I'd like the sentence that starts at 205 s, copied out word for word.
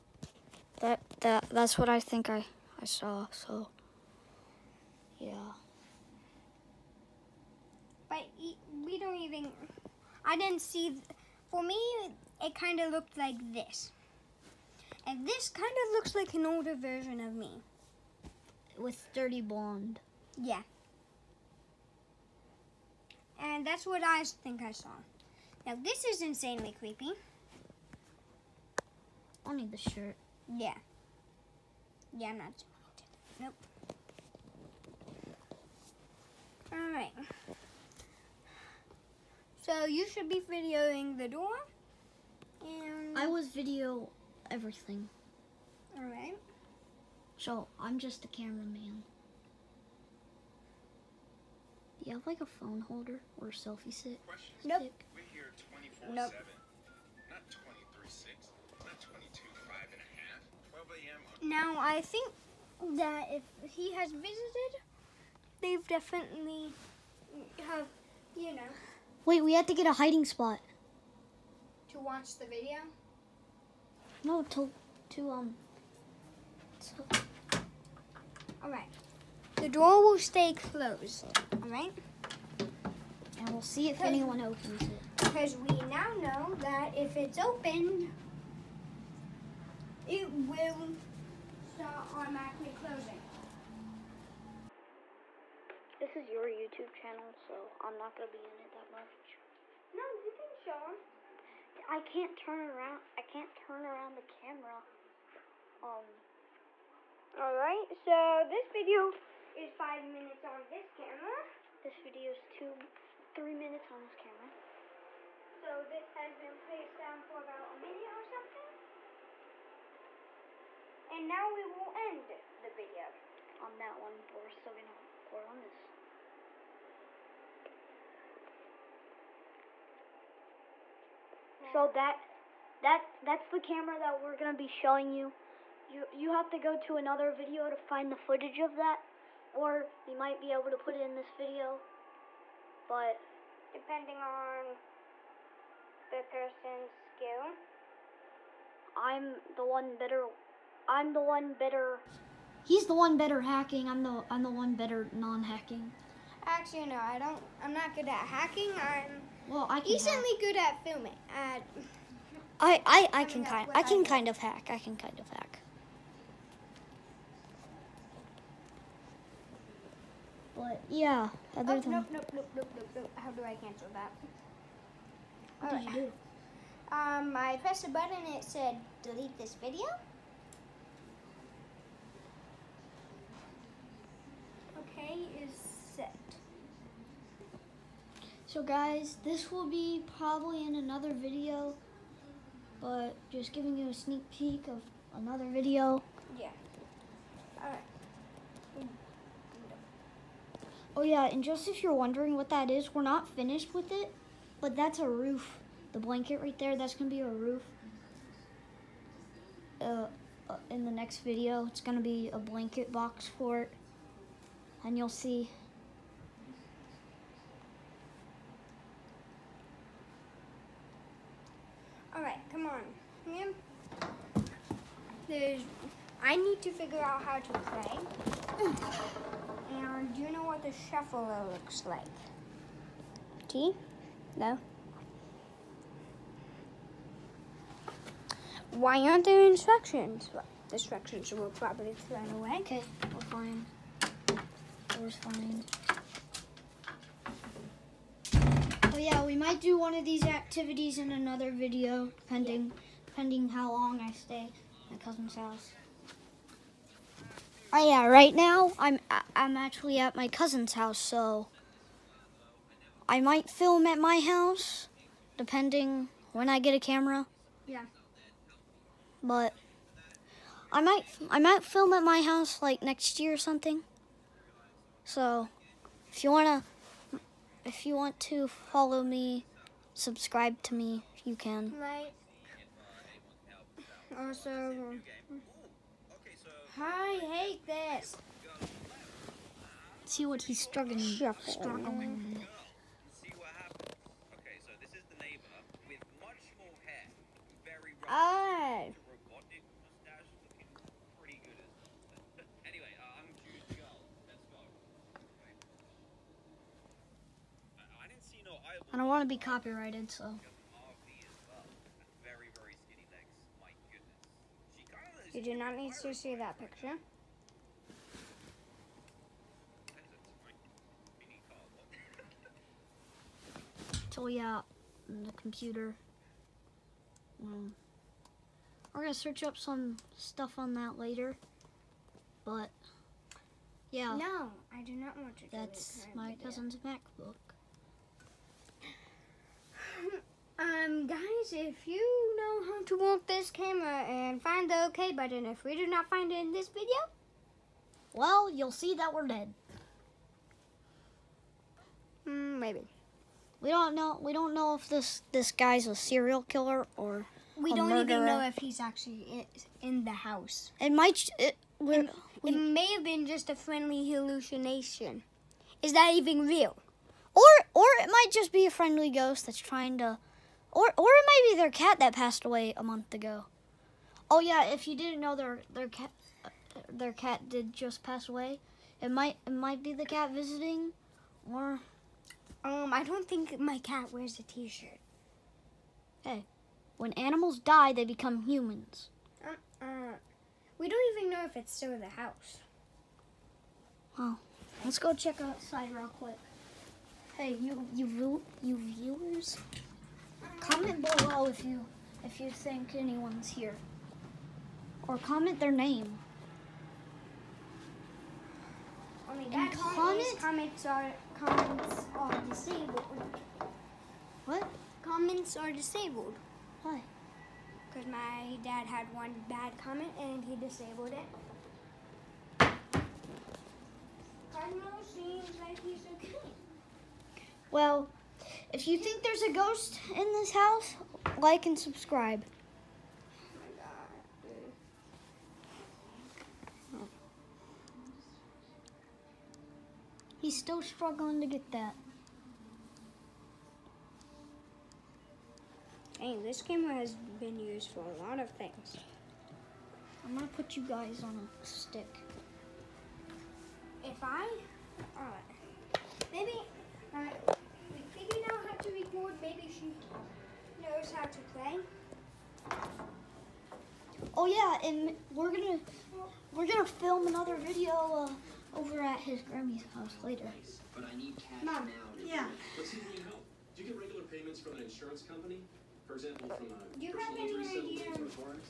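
The blanket right there, that's going to be a roof.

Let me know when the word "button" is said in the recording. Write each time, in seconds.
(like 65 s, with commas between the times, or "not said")
177 s, 345 s.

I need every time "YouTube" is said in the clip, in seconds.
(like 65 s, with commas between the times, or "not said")
96 s.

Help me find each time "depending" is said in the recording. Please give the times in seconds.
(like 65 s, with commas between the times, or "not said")
143 s, 265 s.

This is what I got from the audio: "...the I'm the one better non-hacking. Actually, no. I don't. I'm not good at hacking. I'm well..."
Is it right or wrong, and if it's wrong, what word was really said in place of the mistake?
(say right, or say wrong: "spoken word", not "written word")
right.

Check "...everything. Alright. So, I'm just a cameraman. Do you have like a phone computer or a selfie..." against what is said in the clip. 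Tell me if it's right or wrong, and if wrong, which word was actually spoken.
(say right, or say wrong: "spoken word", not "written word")
wrong: "holder", not "computer".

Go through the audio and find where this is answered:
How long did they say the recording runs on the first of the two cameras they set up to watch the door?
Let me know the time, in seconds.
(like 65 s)
109 s.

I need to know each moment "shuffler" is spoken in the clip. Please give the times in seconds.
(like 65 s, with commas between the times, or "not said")
230 s.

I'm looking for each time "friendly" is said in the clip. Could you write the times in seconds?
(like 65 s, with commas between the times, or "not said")
363 s, 368 s.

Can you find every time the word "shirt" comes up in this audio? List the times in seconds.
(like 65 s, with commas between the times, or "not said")
29 s, 384 s.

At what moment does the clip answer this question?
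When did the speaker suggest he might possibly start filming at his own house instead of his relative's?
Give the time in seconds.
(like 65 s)
272 s.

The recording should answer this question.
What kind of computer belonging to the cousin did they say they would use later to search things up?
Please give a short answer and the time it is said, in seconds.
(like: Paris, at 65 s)
MacBook, at 336 s.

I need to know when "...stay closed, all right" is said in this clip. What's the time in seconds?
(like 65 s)
80 s.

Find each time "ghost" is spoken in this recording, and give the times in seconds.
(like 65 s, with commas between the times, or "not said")
369 s, 429 s.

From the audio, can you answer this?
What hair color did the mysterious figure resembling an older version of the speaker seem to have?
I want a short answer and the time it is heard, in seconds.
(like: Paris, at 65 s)
dirty blonde, at 19 s.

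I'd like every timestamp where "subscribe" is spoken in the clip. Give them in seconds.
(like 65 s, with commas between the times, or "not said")
279 s, 431 s.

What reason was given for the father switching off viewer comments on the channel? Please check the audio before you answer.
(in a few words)
one bad comment.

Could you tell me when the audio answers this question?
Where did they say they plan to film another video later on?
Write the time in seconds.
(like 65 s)
469 s.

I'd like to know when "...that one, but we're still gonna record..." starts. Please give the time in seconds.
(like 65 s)
123 s.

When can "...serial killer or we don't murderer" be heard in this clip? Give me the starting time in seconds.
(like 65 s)
355 s.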